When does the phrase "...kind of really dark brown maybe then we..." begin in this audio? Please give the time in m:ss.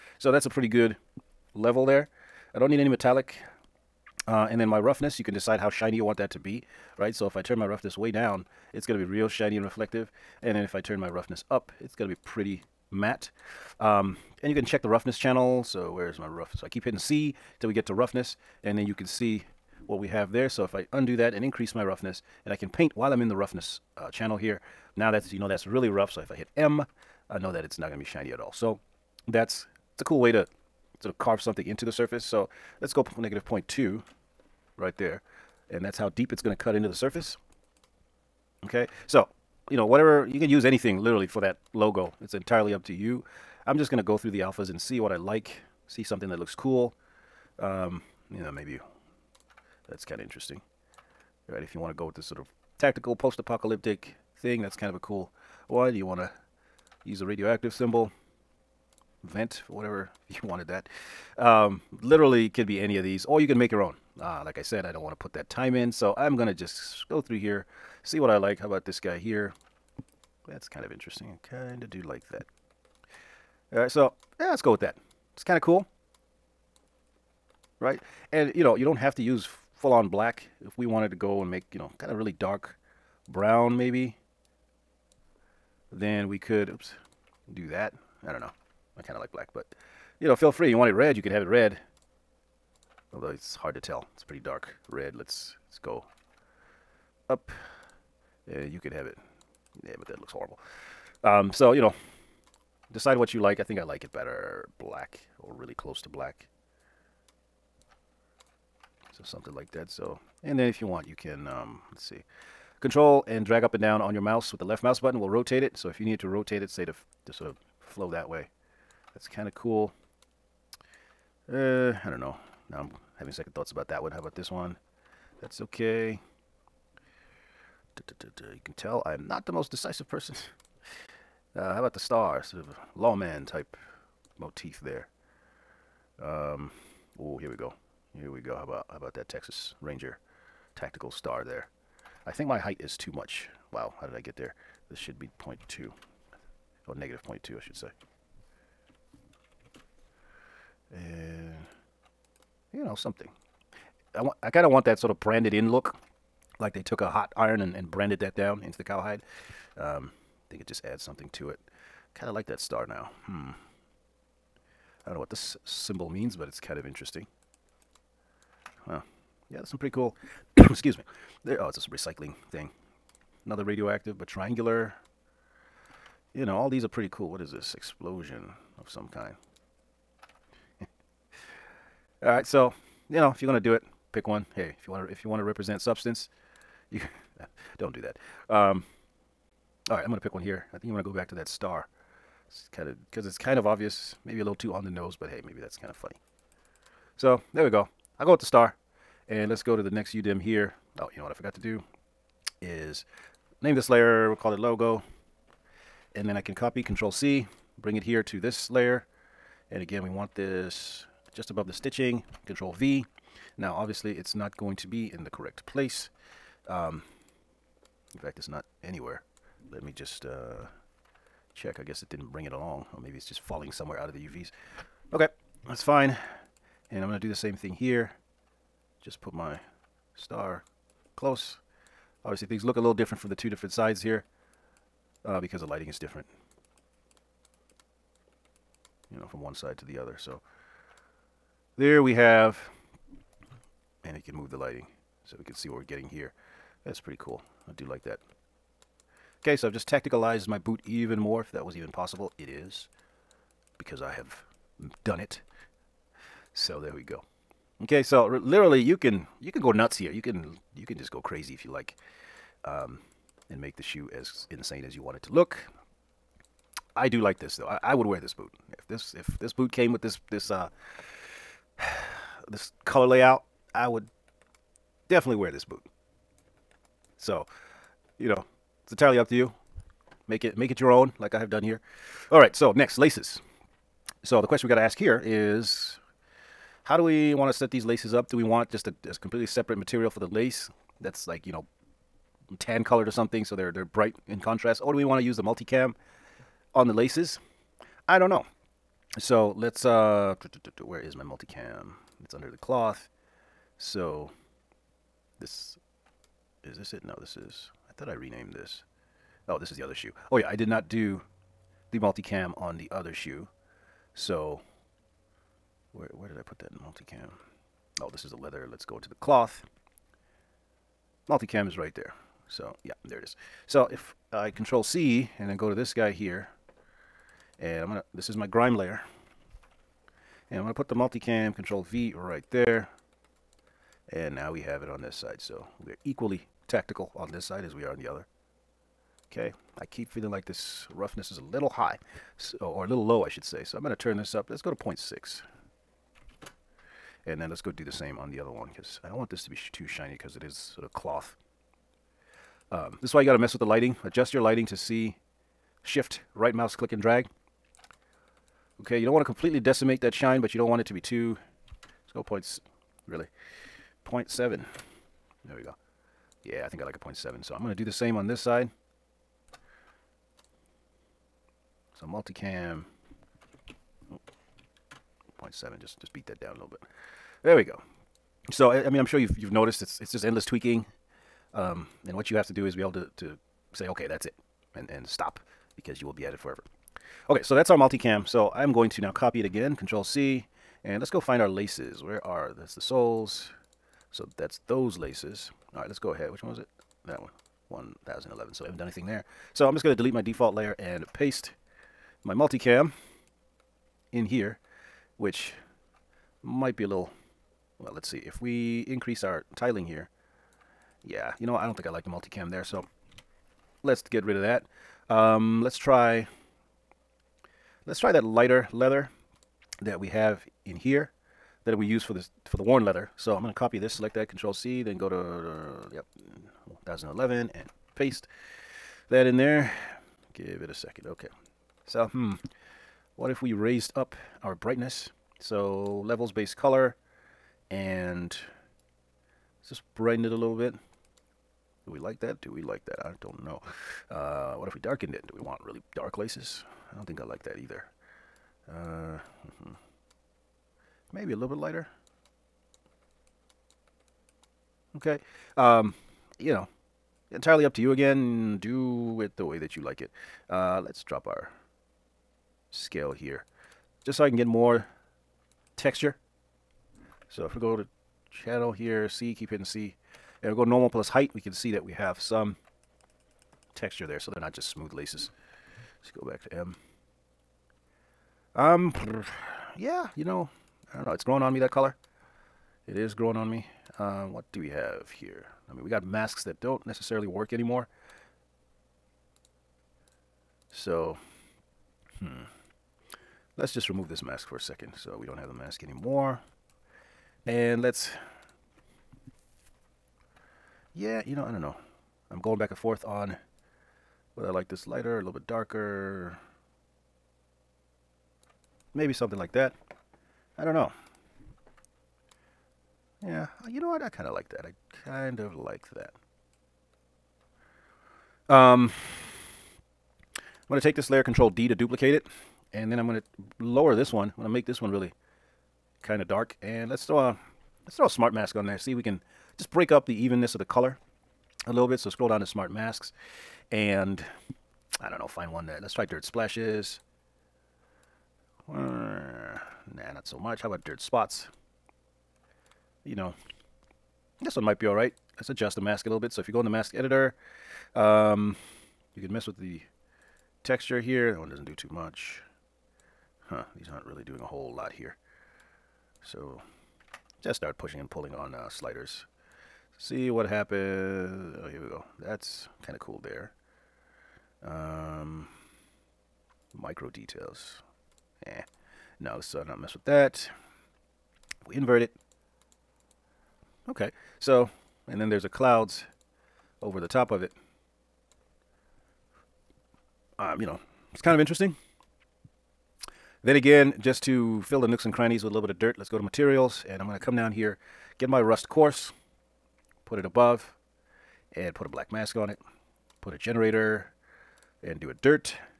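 1:21.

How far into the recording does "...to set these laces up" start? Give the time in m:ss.
4:47.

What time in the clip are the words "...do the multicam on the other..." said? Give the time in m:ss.
5:10.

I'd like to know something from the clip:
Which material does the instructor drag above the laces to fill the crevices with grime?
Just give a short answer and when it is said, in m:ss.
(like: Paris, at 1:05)
rust coarse, at 9:48.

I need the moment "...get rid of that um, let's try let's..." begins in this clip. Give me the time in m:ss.
6:54.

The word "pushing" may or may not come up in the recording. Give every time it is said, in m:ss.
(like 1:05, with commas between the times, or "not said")
9:17.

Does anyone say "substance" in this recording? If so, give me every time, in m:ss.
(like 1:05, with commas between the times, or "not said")
3:05.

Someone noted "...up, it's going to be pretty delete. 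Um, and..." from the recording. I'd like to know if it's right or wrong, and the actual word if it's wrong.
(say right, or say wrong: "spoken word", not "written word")
wrong: "matte", not "delete".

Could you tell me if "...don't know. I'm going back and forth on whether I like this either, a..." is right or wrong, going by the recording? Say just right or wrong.
wrong.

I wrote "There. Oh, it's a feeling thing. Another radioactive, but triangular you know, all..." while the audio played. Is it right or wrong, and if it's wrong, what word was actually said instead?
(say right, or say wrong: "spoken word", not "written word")
wrong: "recycling", not "feeling".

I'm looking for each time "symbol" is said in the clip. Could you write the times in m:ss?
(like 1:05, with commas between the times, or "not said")
0:57, 2:45.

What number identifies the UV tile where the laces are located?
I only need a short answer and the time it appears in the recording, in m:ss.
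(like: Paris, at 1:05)
1011, at 6:37.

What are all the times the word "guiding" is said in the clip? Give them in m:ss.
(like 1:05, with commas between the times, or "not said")
not said.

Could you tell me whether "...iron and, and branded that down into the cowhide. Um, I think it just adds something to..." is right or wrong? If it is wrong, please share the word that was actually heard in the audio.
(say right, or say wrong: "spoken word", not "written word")
right.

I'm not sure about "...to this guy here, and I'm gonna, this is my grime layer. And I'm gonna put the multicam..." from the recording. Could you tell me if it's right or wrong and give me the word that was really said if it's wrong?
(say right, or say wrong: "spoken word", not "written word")
right.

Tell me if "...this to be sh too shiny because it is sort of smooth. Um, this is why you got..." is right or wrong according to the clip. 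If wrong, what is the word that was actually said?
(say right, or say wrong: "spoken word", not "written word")
wrong: "cloth", not "smooth".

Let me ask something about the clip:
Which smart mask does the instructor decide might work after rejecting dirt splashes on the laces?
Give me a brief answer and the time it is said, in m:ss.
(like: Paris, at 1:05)
dirt spots, at 9:00.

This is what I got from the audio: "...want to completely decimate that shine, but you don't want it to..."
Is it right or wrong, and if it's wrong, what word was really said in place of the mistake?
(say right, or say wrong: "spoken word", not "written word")
right.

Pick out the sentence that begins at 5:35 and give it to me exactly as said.
So we're equally tactical on this side as we are on the other.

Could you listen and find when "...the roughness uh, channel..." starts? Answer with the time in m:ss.
0:23.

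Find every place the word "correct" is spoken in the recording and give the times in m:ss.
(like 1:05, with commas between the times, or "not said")
3:35.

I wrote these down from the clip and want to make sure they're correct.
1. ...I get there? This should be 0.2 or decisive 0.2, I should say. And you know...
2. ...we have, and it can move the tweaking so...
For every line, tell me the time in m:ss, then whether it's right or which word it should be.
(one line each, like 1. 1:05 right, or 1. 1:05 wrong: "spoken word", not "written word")
1. 2:24 wrong: "negative", not "decisive"
2. 4:02 wrong: "lighting", not "tweaking".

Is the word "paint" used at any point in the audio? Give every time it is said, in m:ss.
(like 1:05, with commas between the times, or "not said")
0:22.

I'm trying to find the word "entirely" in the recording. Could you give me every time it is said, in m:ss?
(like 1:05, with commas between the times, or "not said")
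0:42, 4:38, 7:37.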